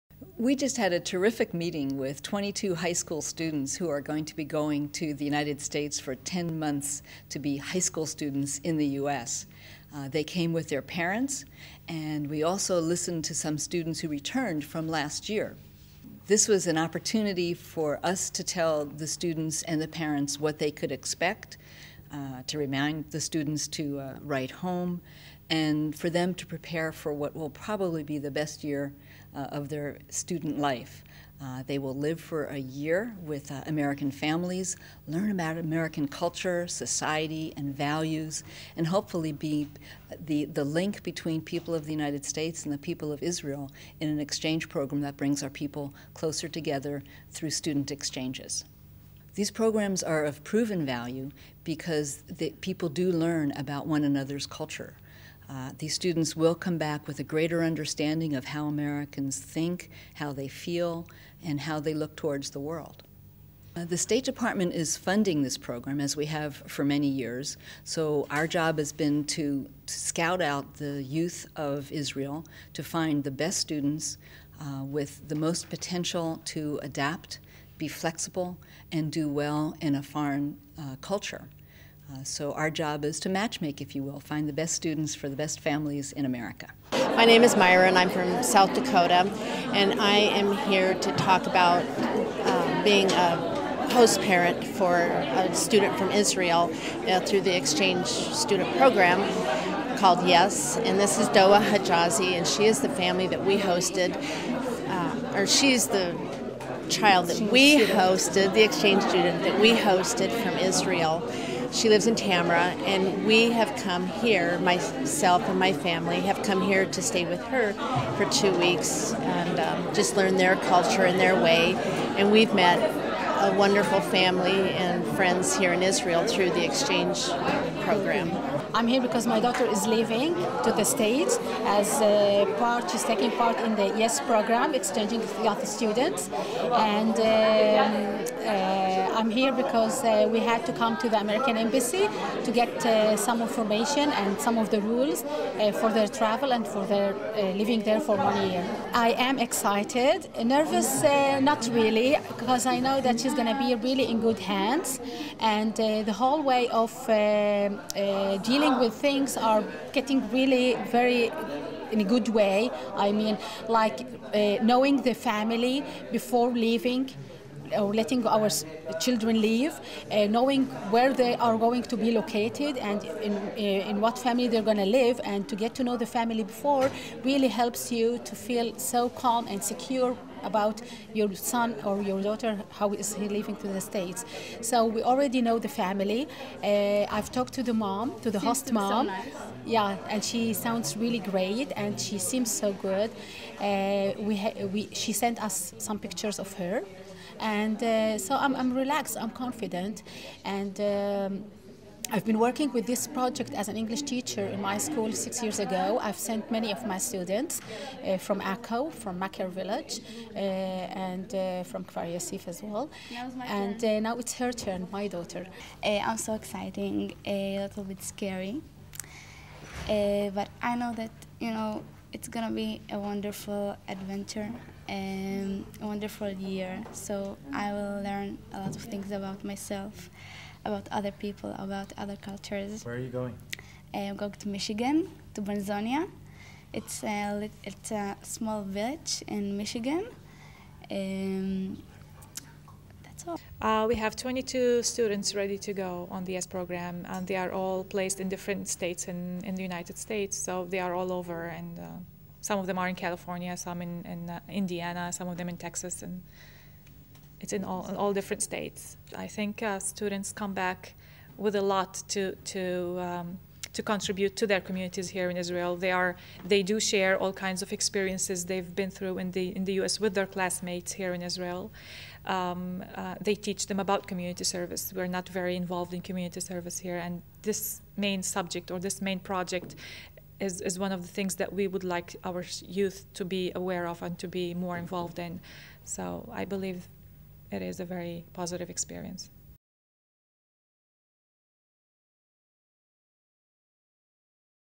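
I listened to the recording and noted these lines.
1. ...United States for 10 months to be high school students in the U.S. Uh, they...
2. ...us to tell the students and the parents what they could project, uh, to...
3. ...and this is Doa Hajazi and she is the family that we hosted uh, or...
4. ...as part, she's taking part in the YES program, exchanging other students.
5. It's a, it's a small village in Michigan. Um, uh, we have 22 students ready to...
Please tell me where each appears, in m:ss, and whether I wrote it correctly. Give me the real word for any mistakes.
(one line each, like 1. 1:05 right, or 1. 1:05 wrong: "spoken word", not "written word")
1. 0:05 right
2. 0:18 wrong: "expect", not "project"
3. 1:40 right
4. 2:11 right
5. 3:56 right.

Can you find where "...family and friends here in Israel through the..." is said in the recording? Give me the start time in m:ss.
2:04.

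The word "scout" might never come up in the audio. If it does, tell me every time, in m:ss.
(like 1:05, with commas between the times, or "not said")
1:09.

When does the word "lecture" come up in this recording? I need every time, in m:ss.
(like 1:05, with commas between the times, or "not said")
not said.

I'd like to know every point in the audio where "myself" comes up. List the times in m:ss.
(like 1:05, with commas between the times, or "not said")
1:54, 3:49.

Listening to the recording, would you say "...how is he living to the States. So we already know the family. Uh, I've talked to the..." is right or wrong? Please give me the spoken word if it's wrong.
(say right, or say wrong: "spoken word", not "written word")
right.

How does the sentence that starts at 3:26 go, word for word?
I've sent many of my students uh, from ACO, from Makar village, uh, and uh, from Kfar as well.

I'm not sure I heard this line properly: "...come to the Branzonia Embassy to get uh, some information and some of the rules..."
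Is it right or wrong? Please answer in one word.
wrong.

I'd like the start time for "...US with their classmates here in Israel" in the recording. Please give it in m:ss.
4:29.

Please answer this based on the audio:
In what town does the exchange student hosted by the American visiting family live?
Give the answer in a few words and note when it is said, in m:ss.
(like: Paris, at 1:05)
Tamra, at 1:52.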